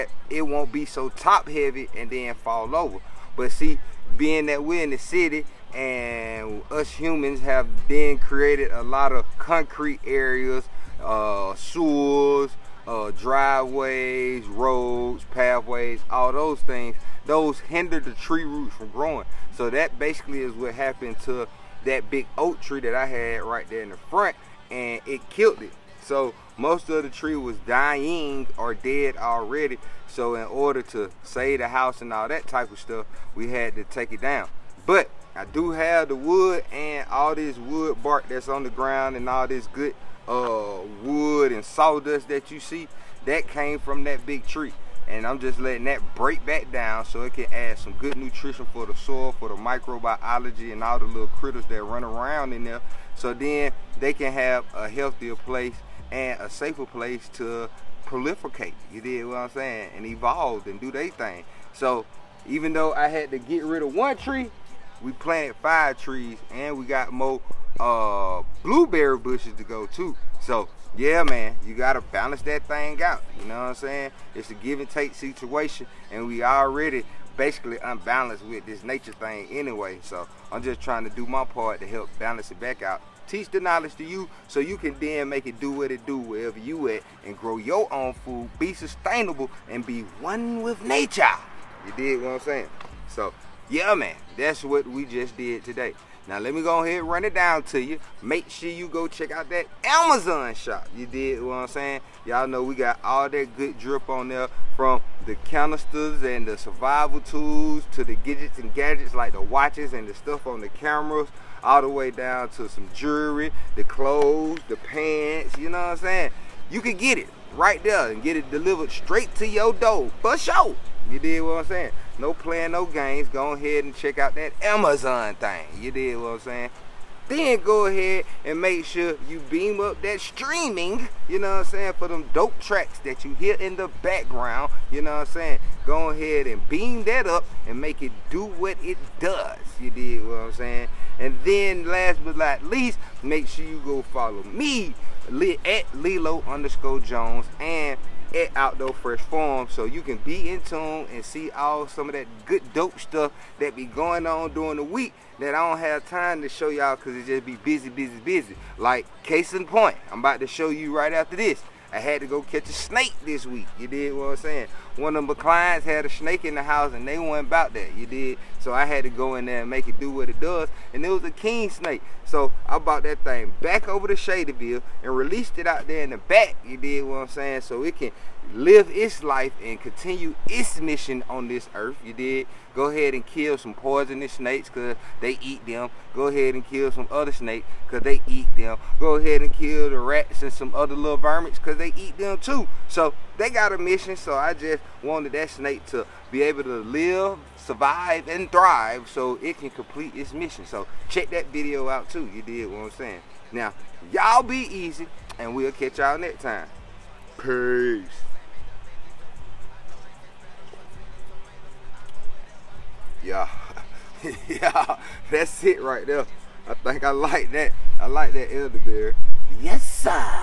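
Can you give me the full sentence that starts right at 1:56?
You can get it right there and get it delivered straight to your door for sure.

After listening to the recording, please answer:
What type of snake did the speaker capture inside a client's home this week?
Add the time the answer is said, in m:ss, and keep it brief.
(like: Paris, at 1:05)
King snake, at 2:51.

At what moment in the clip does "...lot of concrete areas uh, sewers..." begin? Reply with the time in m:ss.
0:08.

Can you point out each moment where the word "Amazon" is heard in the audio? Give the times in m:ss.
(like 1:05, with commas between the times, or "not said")
1:39, 2:04.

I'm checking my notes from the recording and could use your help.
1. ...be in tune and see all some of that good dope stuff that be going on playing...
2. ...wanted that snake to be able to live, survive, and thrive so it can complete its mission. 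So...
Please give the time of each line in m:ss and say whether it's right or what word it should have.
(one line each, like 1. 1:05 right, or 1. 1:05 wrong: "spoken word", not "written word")
1. 2:30 wrong: "during", not "playing"
2. 3:15 right.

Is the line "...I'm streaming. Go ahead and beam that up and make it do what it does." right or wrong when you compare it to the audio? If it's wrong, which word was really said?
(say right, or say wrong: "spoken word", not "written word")
wrong: "saying", not "streaming".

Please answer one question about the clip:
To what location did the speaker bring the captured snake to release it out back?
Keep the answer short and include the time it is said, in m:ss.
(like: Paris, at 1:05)
Shadyville, at 2:54.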